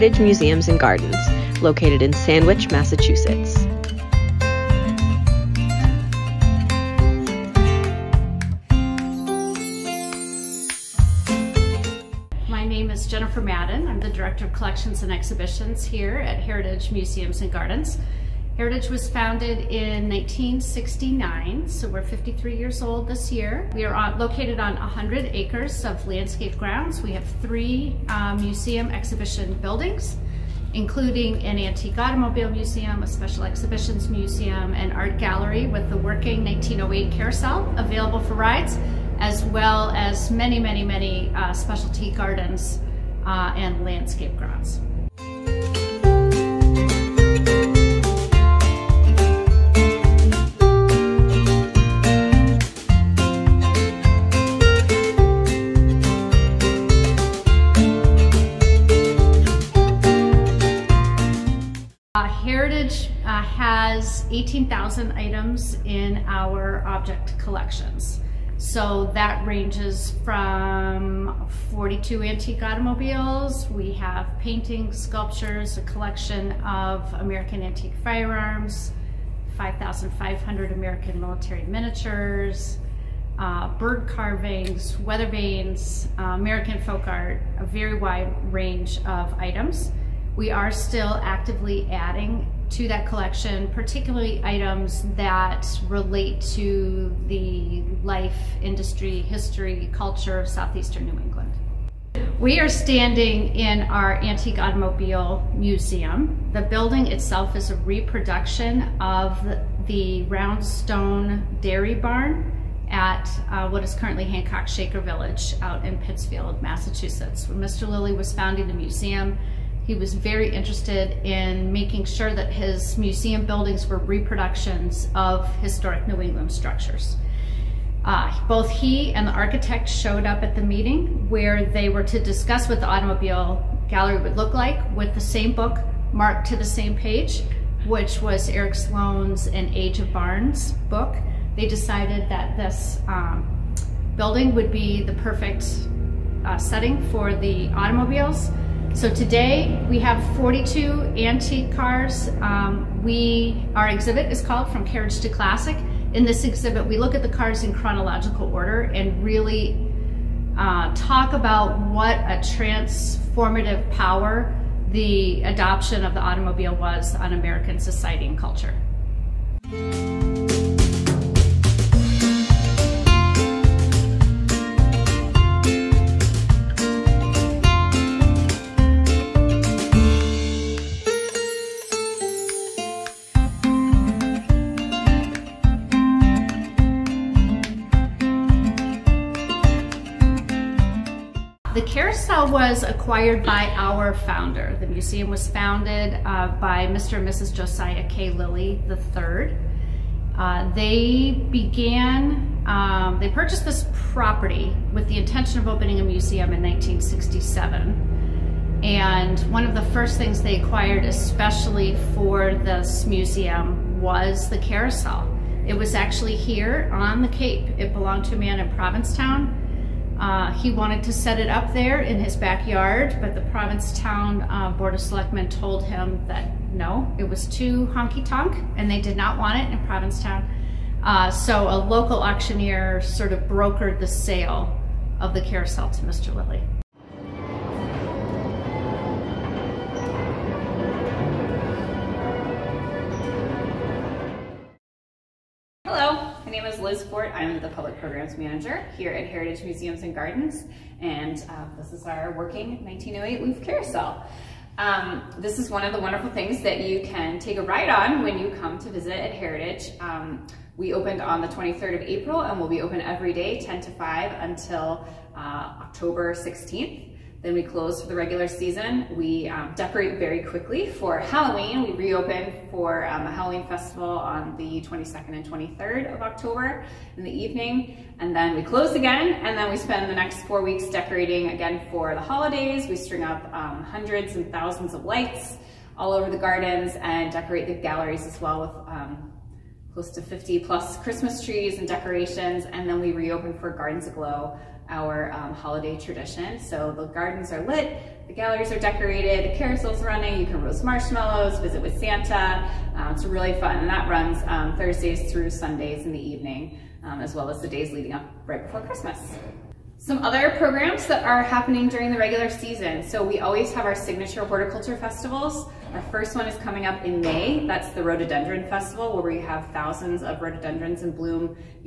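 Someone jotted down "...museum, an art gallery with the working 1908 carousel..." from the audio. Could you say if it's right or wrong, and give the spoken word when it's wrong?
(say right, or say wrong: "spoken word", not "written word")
right.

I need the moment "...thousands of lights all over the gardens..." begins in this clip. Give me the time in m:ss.
4:44.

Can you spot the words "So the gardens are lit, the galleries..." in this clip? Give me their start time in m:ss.
4:56.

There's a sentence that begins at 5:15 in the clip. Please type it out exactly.
Our first one is coming up in May.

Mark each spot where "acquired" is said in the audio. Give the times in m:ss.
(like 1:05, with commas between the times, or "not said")
3:13, 3:30.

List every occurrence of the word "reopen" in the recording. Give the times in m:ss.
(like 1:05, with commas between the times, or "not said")
4:31, 4:53.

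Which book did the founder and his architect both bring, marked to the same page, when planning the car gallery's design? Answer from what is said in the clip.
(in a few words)
An Age of Barns.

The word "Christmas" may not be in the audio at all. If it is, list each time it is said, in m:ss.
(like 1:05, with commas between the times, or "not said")
4:51, 5:08.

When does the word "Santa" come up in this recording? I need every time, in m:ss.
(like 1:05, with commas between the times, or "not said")
5:01.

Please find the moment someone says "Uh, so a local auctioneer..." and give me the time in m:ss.
3:51.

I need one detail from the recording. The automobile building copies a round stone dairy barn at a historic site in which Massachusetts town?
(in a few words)
Pittsfield.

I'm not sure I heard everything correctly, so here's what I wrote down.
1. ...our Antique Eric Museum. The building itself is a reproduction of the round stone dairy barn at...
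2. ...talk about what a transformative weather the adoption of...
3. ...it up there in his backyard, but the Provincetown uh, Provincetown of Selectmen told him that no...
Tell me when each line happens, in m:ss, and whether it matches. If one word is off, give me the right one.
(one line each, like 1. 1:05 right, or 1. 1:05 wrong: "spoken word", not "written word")
1. 1:43 wrong: "Automobile", not "Eric"
2. 2:40 wrong: "power", not "weather"
3. 3:41 wrong: "Board", not "Provincetown".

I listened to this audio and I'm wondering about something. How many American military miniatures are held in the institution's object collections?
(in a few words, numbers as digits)
5,500.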